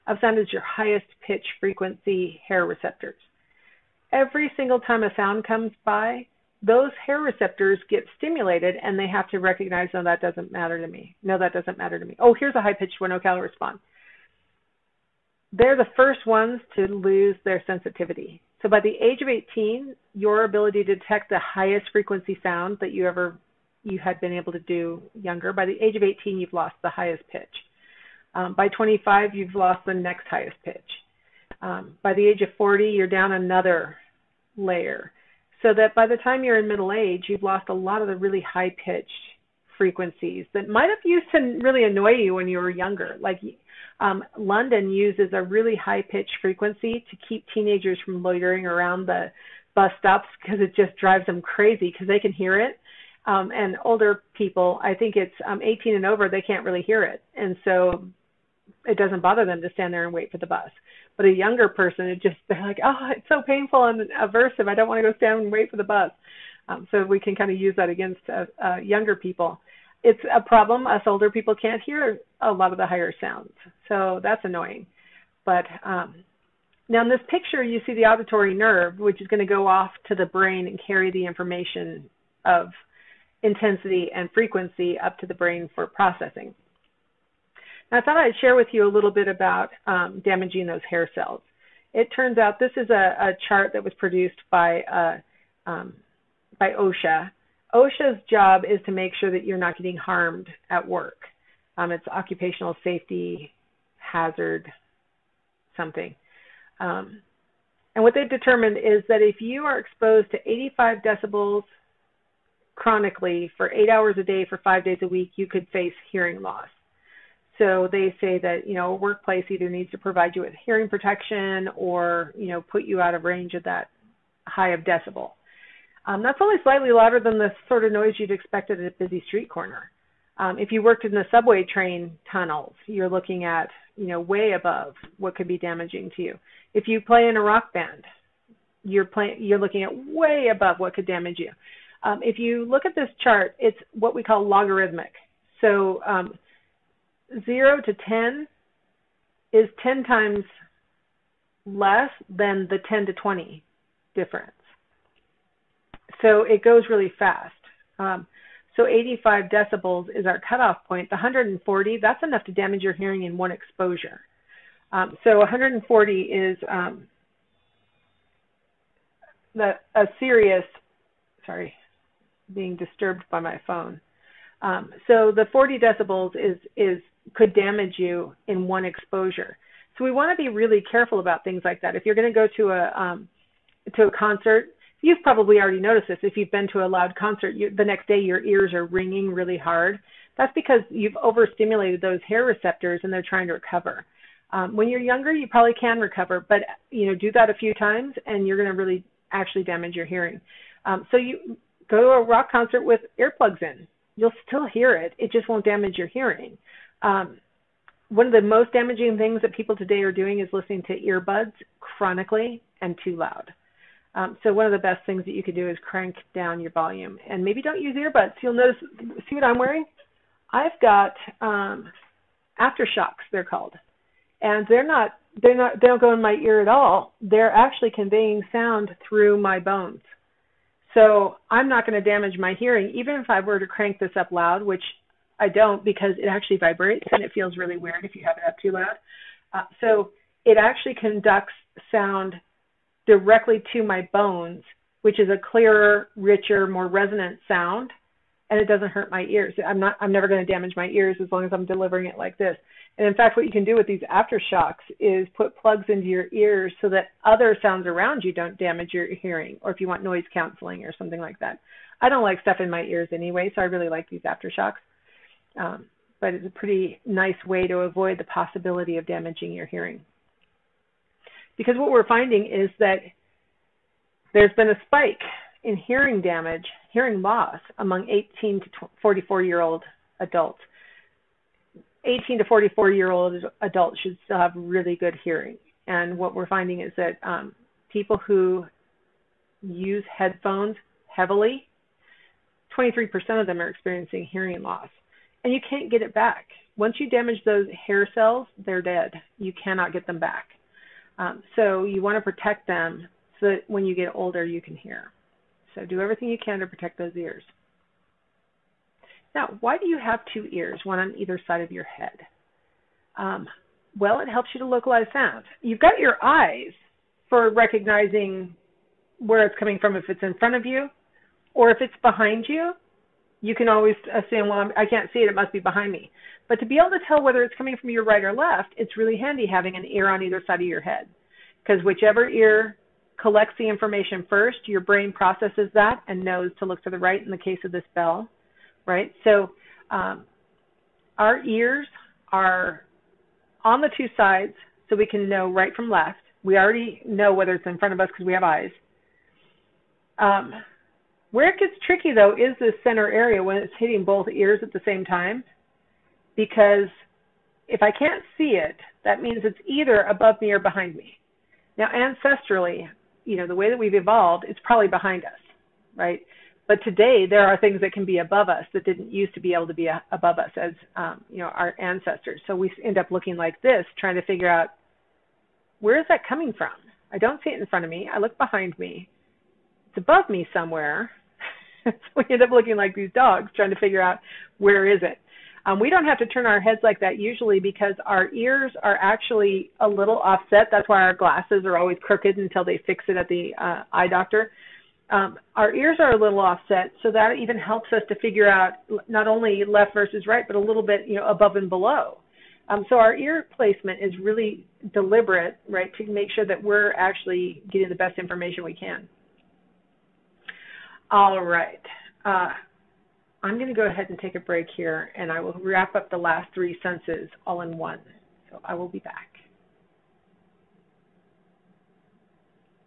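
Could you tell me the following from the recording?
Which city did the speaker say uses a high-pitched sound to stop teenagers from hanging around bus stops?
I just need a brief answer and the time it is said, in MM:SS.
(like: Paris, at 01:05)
London, at 00:44.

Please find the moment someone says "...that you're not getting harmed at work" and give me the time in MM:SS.
01:39.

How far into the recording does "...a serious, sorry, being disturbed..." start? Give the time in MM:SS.
02:49.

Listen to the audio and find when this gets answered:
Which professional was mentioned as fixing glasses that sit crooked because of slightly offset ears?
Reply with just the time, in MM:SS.
06:33.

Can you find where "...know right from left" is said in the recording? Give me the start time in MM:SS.
05:45.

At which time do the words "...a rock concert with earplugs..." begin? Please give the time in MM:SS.
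03:22.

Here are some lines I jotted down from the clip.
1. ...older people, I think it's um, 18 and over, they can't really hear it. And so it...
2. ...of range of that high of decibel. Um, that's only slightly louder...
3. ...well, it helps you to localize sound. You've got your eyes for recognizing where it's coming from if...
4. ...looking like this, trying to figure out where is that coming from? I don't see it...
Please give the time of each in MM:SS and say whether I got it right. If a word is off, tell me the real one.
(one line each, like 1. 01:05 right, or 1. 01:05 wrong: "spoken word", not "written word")
1. 00:53 right
2. 02:03 right
3. 05:13 right
4. 06:13 right.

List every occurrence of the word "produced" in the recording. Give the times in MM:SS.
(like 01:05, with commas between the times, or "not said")
01:33.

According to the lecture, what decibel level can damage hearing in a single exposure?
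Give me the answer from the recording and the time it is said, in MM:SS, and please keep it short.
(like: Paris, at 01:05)
140, at 02:41.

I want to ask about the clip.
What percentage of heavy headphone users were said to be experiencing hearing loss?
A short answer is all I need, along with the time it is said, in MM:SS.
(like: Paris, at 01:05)
23%, at 04:52.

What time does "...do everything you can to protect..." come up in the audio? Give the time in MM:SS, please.
05:05.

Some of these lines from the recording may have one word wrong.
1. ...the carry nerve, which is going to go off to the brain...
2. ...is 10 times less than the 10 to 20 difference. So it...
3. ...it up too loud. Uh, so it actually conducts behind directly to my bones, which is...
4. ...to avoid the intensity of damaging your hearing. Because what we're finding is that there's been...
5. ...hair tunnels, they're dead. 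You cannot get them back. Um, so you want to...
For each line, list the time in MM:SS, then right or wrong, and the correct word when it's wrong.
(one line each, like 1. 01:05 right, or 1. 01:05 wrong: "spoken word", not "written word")
1. 01:17 wrong: "auditory", not "carry"
2. 02:29 right
3. 03:58 wrong: "sound", not "behind"
4. 04:27 wrong: "possibility", not "intensity"
5. 04:57 wrong: "cells", not "tunnels".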